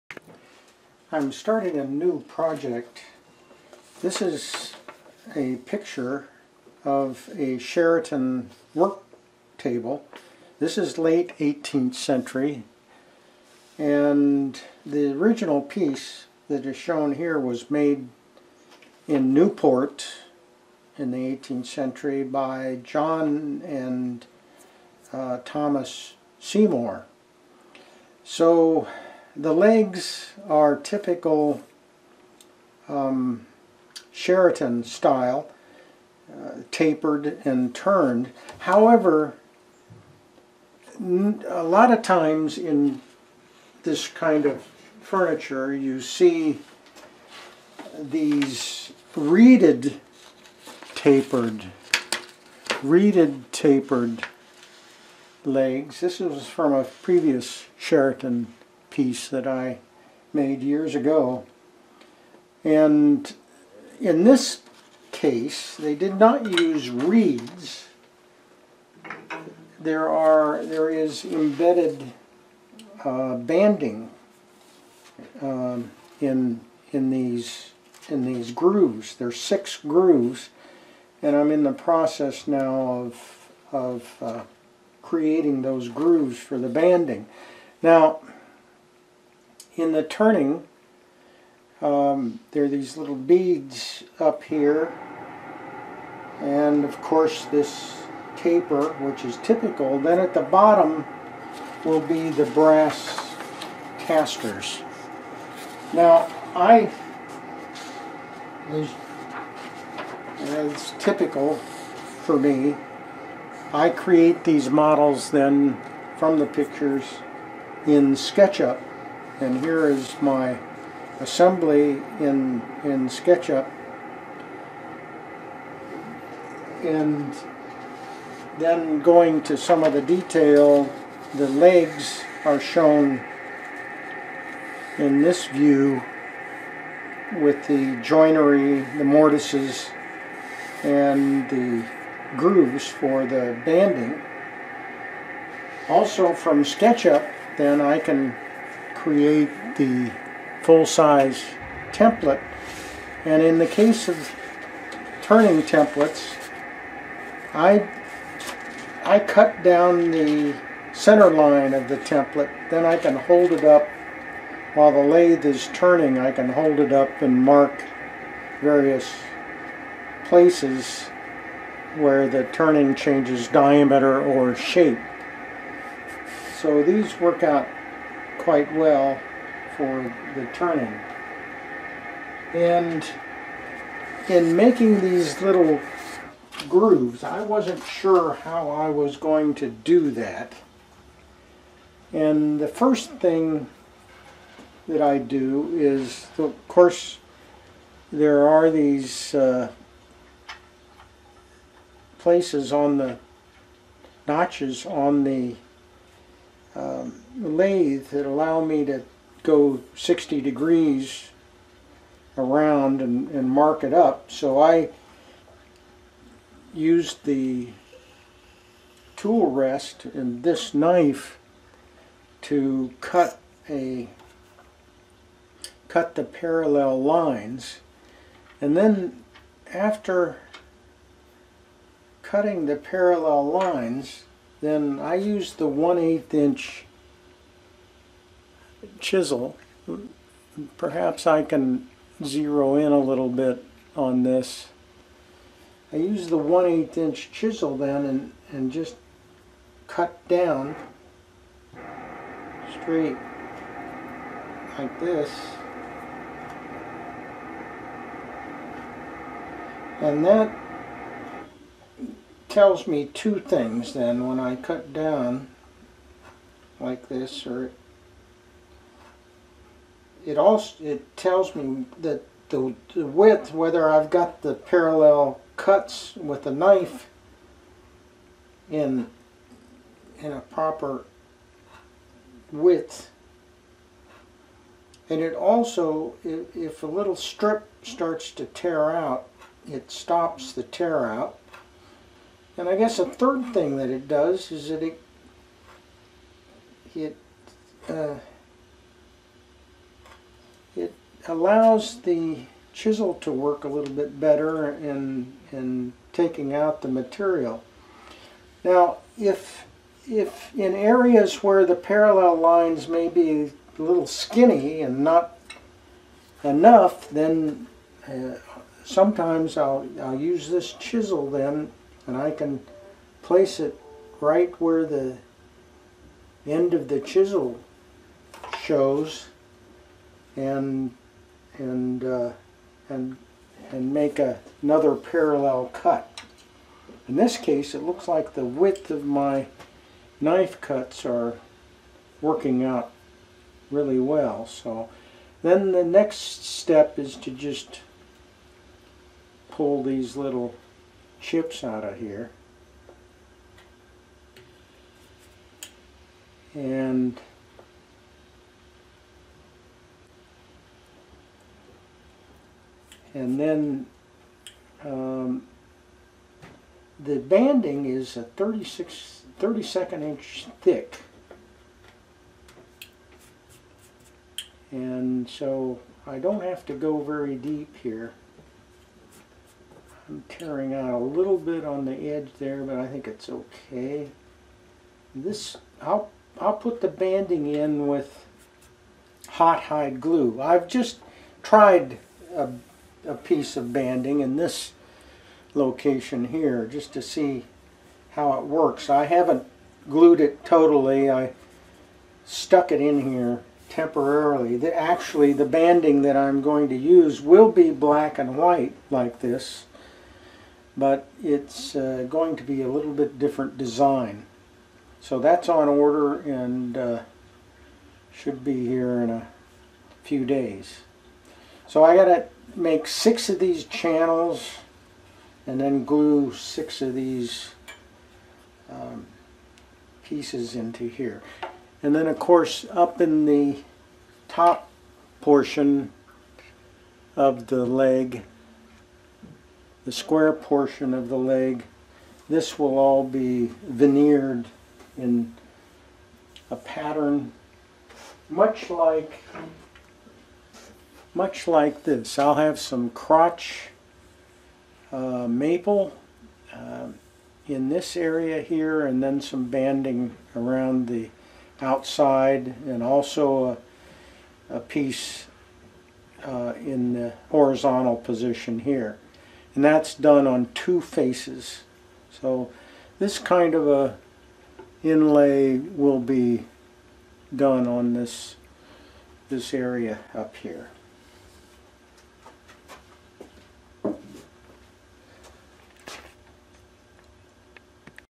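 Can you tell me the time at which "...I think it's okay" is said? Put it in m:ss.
6:22.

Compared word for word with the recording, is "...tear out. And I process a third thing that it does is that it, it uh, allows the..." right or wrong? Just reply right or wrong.
wrong.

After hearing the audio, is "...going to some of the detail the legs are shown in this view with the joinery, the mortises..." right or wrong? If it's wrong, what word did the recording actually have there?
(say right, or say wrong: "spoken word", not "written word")
right.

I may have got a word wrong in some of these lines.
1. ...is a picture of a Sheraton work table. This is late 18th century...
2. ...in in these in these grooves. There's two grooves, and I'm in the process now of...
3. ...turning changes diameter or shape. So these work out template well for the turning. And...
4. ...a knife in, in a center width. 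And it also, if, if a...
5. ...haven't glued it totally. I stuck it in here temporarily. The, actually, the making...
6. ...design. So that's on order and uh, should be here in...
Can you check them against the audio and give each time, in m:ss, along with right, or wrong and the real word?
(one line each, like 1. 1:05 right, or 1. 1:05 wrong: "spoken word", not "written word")
1. 0:04 right
2. 1:16 wrong: "six", not "two"
3. 2:52 wrong: "quite", not "template"
4. 4:36 wrong: "proper", not "center"
5. 6:39 wrong: "banding", not "making"
6. 6:53 right.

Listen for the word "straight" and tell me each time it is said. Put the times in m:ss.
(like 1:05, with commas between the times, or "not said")
4:12.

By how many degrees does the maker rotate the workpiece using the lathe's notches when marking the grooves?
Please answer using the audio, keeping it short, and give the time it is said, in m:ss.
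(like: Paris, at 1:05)
60 degrees, at 3:29.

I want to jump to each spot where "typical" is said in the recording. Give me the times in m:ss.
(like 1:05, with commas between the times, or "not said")
0:30, 1:39, 1:50.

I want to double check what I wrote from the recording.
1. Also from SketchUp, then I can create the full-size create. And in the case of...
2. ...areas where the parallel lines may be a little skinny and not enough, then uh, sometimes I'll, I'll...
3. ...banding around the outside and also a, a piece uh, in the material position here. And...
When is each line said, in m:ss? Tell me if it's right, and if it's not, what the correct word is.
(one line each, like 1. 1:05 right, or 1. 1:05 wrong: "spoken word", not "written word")
1. 2:25 wrong: "template", not "create"
2. 5:10 right
3. 7:39 wrong: "horizontal", not "material".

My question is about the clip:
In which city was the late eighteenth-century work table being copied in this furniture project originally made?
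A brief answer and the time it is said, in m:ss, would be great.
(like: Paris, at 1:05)
Newport, at 0:19.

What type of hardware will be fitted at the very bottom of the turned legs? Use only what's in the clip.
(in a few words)
brass casters.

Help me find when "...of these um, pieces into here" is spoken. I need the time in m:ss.
7:06.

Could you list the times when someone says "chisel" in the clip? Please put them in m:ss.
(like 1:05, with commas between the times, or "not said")
3:58, 4:07, 5:02, 5:20, 5:26.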